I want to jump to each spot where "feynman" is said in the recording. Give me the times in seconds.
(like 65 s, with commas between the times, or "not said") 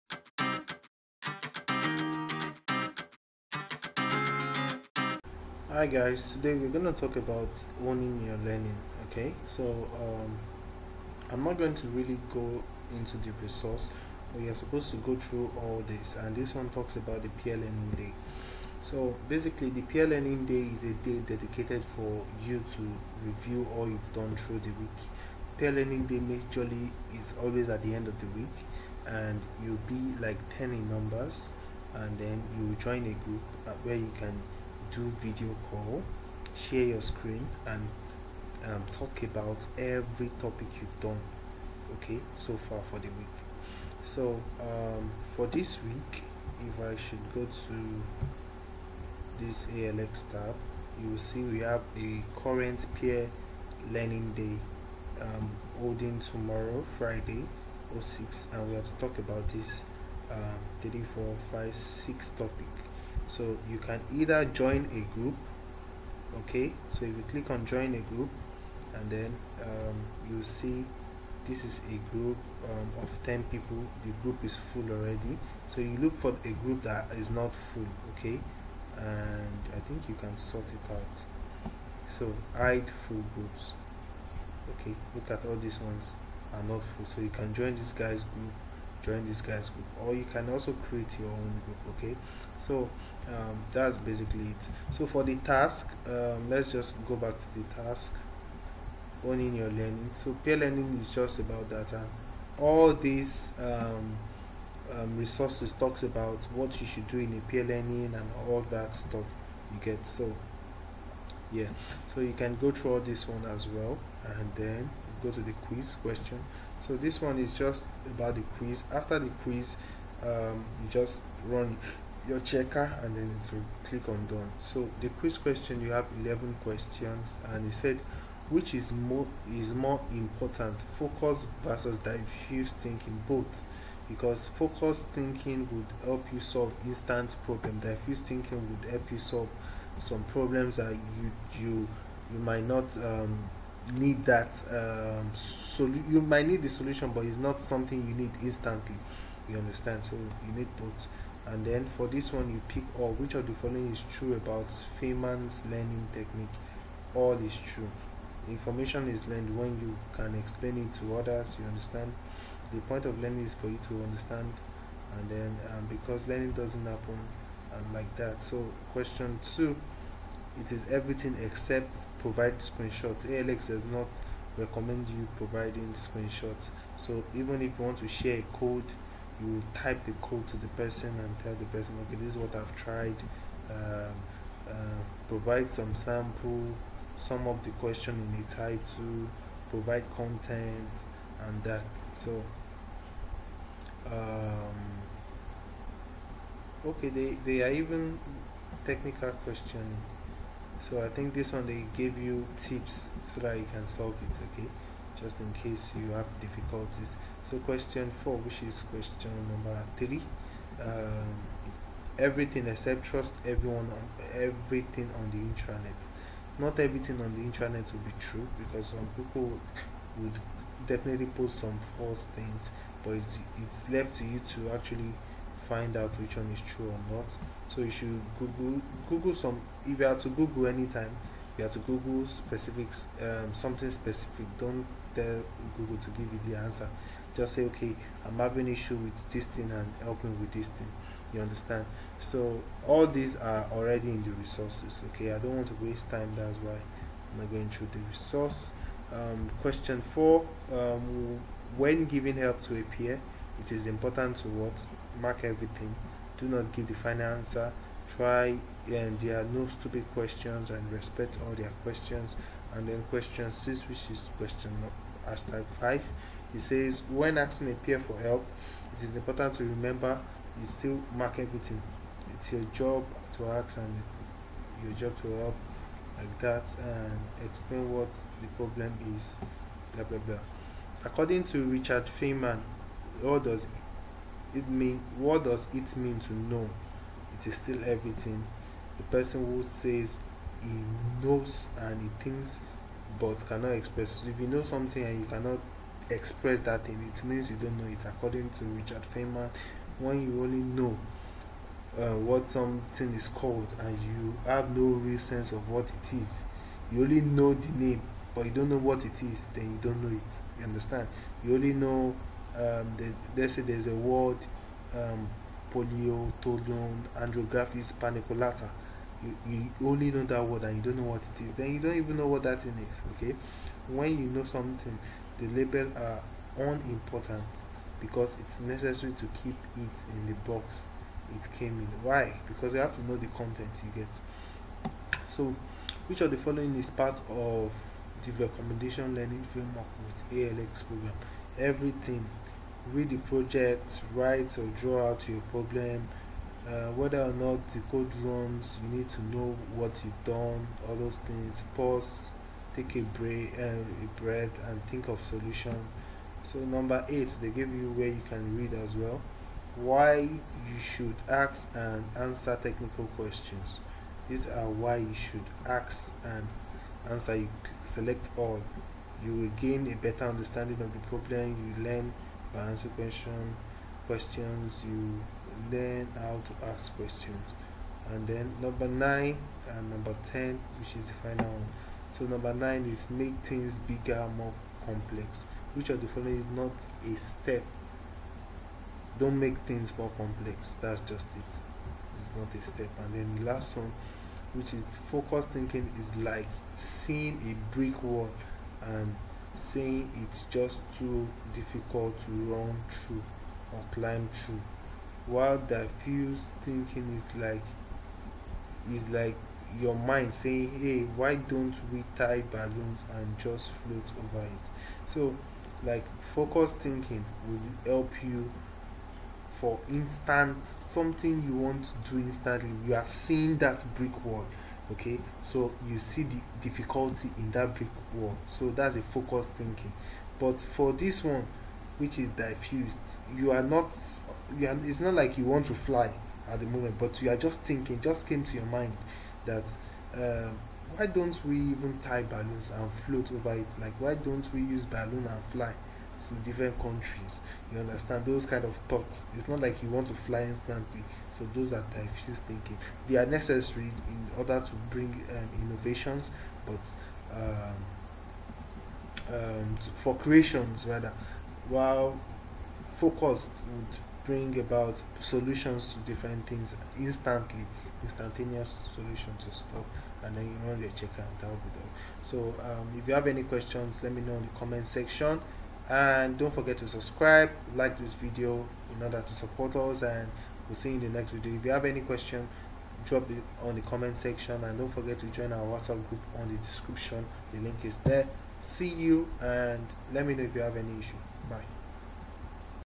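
155 s, 282 s, 299 s.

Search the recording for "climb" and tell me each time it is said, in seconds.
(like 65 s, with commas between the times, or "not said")
403 s.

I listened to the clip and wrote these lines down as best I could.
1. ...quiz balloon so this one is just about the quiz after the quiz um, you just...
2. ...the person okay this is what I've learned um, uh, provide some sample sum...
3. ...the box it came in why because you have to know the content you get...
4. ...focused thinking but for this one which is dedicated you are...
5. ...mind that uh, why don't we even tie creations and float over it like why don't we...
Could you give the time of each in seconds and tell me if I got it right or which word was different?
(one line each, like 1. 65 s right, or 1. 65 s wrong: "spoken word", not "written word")
1. 115 s wrong: "question", not "balloon"
2. 181 s wrong: "tried", not "learned"
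3. 330 s right
4. 429 s wrong: "diffused", not "dedicated"
5. 438 s wrong: "balloons", not "creations".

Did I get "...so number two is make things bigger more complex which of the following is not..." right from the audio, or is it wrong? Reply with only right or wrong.
wrong.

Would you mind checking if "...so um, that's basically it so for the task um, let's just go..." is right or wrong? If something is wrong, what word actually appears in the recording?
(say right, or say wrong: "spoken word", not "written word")
right.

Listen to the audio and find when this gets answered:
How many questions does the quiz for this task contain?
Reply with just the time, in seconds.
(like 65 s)
126 s.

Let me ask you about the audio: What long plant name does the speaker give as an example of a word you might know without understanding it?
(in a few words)
andrographis paniculata.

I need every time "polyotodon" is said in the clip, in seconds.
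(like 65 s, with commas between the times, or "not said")
315 s.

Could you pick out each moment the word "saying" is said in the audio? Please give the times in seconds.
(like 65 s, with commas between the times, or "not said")
399 s, 410 s.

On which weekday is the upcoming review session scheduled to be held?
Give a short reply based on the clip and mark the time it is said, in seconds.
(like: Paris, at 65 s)
Friday, at 56 s.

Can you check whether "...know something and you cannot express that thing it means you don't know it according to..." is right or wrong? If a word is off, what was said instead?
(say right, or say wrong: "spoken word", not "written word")
right.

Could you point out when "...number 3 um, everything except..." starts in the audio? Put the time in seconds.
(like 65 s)
209 s.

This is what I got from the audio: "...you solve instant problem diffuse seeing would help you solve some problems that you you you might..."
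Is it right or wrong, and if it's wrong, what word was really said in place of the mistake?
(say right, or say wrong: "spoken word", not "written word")
wrong: "thinking", not "seeing".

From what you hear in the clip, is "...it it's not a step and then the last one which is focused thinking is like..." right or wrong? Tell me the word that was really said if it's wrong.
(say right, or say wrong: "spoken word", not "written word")
right.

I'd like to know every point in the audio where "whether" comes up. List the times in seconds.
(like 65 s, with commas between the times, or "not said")
346 s.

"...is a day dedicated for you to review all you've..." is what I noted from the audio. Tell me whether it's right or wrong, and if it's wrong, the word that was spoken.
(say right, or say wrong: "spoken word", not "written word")
right.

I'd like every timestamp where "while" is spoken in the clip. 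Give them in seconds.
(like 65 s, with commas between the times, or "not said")
405 s, 461 s.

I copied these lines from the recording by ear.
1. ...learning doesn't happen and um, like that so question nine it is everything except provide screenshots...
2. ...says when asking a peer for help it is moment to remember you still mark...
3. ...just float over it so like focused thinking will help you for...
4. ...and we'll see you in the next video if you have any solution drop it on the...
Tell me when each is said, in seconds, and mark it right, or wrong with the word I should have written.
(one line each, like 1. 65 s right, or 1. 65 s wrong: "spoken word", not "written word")
1. 166 s wrong: "two", not "nine"
2. 266 s wrong: "important", not "moment"
3. 413 s right
4. 480 s wrong: "question", not "solution".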